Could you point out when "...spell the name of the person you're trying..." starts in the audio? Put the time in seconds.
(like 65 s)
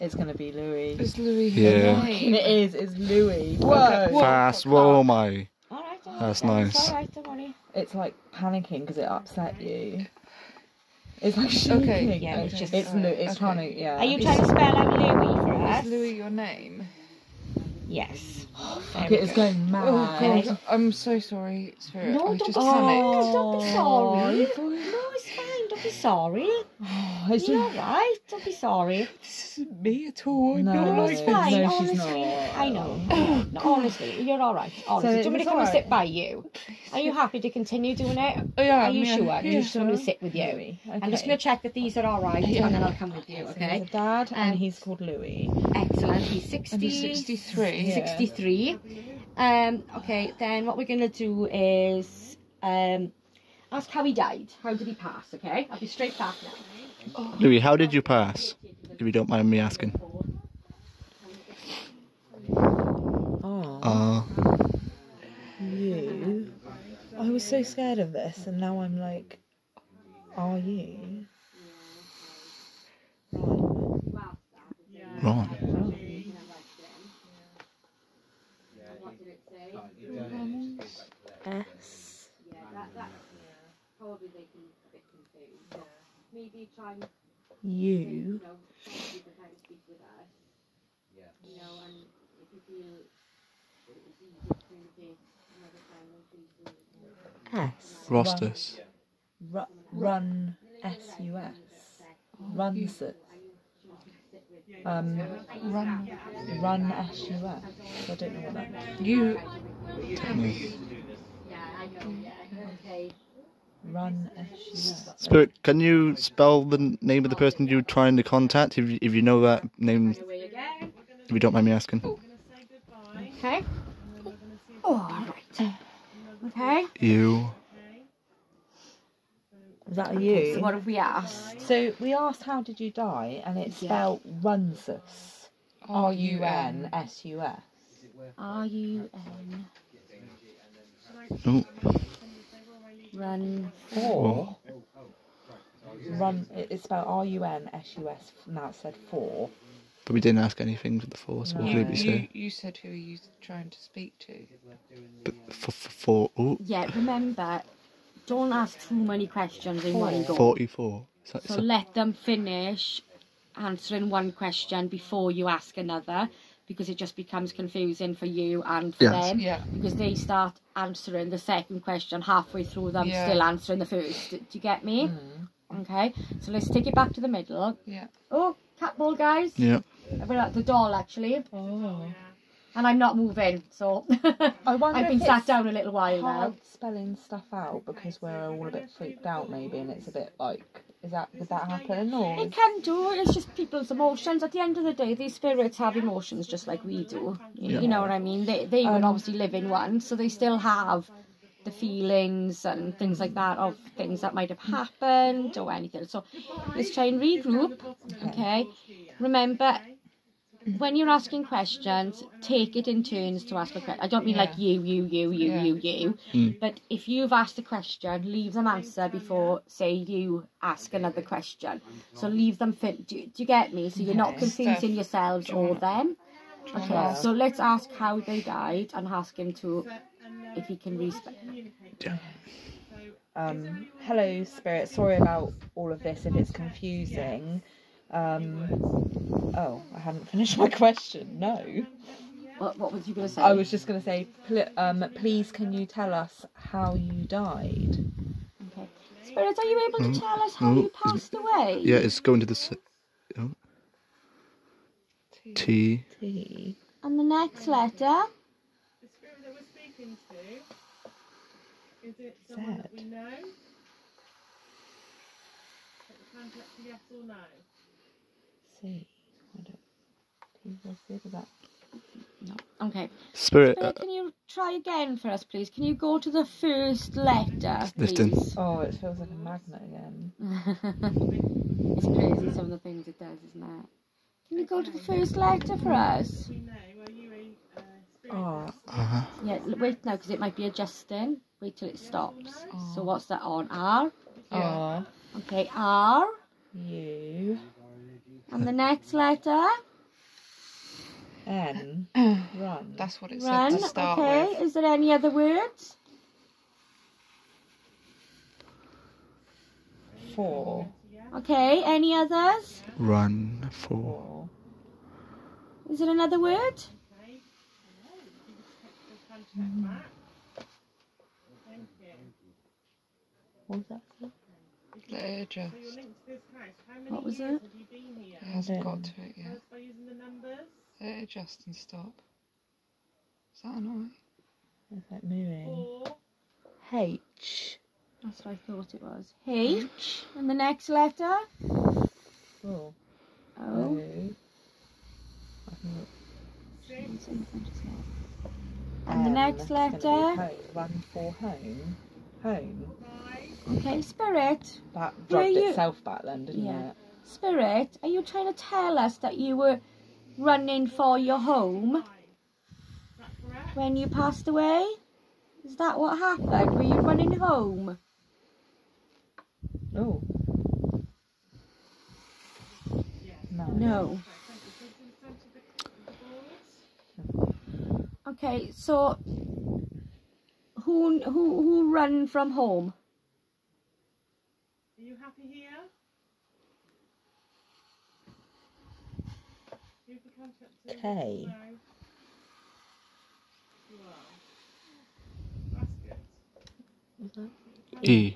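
116 s.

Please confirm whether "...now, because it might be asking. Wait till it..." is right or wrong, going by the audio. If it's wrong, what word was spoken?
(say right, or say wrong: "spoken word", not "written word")
wrong: "adjusting", not "asking".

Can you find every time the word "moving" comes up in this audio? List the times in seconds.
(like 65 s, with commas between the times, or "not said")
183 s, 335 s.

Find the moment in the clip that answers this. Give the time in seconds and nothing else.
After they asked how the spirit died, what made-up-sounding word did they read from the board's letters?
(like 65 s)
134 s.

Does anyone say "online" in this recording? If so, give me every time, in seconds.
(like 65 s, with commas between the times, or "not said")
not said.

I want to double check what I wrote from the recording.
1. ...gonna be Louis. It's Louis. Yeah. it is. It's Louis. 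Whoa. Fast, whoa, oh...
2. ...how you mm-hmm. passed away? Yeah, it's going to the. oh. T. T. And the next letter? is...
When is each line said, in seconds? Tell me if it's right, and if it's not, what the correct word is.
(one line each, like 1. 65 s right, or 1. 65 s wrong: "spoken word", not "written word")
1. 0 s right
2. 250 s right.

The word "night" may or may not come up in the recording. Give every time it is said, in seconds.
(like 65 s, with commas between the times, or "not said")
not said.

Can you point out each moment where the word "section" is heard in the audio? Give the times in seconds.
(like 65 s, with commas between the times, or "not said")
not said.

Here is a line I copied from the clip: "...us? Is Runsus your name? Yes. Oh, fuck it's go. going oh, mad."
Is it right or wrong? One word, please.
wrong.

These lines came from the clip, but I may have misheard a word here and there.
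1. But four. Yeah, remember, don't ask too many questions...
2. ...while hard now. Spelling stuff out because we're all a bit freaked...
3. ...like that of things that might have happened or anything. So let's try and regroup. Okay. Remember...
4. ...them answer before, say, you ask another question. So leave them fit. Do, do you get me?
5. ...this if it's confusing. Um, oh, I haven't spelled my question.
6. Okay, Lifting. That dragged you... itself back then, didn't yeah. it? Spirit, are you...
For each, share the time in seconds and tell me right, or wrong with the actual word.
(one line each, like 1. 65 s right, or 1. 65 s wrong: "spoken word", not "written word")
1. 155 s right
2. 185 s right
3. 203 s right
4. 218 s right
5. 236 s wrong: "finished", not "spelled"
6. 353 s wrong: "Spirit", not "Lifting".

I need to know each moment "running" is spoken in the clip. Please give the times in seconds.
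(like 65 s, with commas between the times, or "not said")
360 s, 366 s.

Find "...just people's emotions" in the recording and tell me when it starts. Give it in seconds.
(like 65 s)
193 s.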